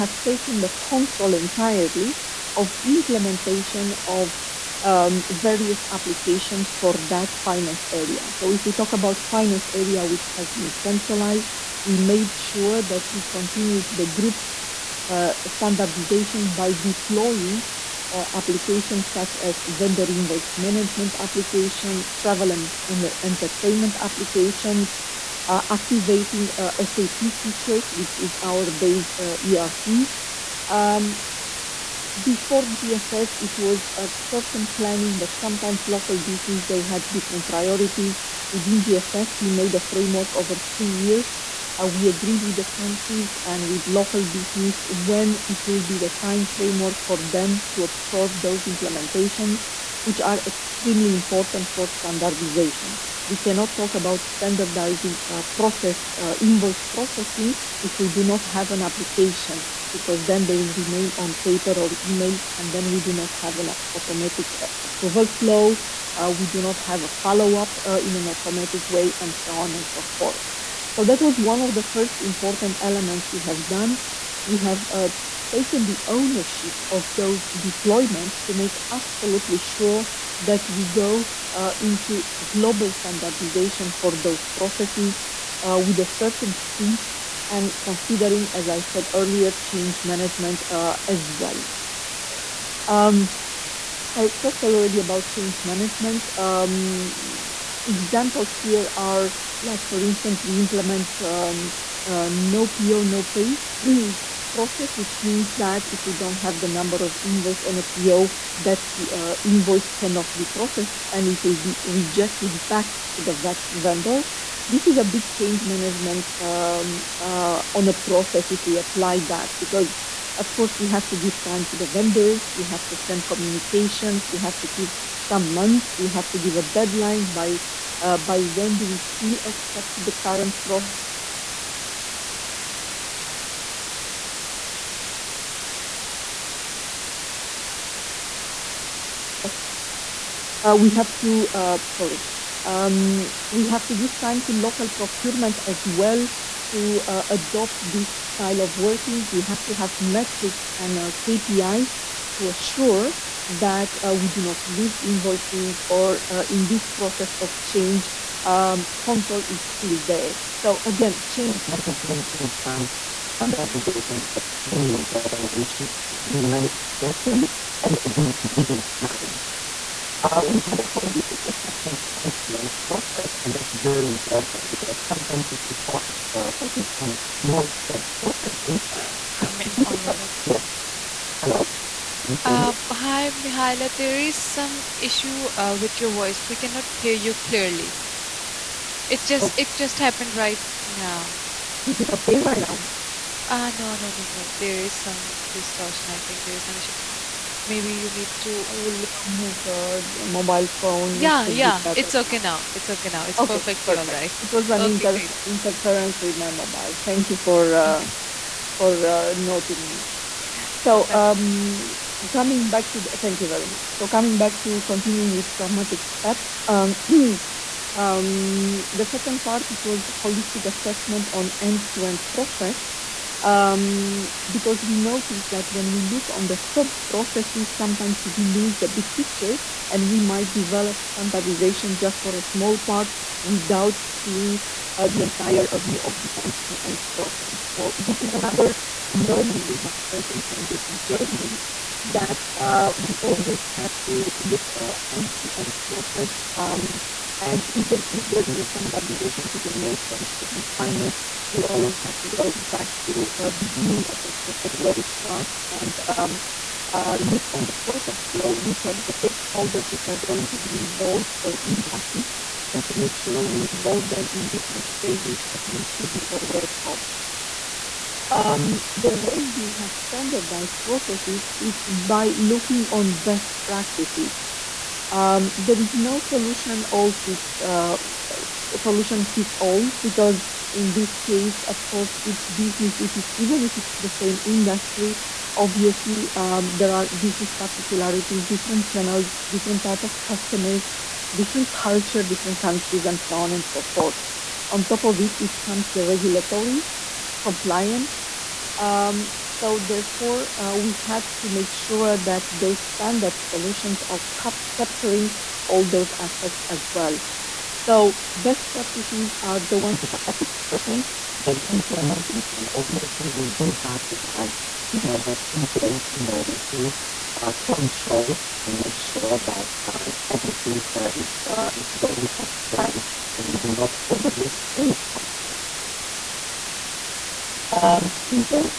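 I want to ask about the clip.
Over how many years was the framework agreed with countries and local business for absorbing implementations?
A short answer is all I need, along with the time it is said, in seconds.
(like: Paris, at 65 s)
3, at 40 s.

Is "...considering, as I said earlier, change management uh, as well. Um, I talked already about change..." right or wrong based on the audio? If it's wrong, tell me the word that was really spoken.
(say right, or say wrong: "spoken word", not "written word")
right.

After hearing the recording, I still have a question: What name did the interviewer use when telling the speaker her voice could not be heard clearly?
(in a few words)
Mihaila.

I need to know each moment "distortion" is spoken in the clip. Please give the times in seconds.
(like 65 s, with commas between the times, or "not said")
195 s.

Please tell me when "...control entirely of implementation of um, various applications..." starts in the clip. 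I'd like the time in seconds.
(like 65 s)
0 s.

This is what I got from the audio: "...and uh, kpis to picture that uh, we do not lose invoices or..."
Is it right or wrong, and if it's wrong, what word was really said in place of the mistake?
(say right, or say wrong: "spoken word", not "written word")
wrong: "assure", not "picture".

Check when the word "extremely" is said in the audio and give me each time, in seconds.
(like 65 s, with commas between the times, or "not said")
50 s, 164 s.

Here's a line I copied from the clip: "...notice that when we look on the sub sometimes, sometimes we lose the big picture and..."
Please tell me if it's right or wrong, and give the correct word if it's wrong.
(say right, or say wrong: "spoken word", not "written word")
wrong: "processes", not "sometimes".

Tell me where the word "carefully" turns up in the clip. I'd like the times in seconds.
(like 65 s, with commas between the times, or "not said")
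166 s.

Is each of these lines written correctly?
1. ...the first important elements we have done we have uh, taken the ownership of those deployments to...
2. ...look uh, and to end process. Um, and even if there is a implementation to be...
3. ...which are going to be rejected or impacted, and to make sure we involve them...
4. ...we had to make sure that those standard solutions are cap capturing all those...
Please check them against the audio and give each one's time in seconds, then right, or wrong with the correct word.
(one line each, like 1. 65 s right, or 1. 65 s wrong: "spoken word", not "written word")
1. 71 s right
2. 244 s wrong: "standardization", not "implementation"
3. 259 s wrong: "involved", not "rejected"
4. 300 s right.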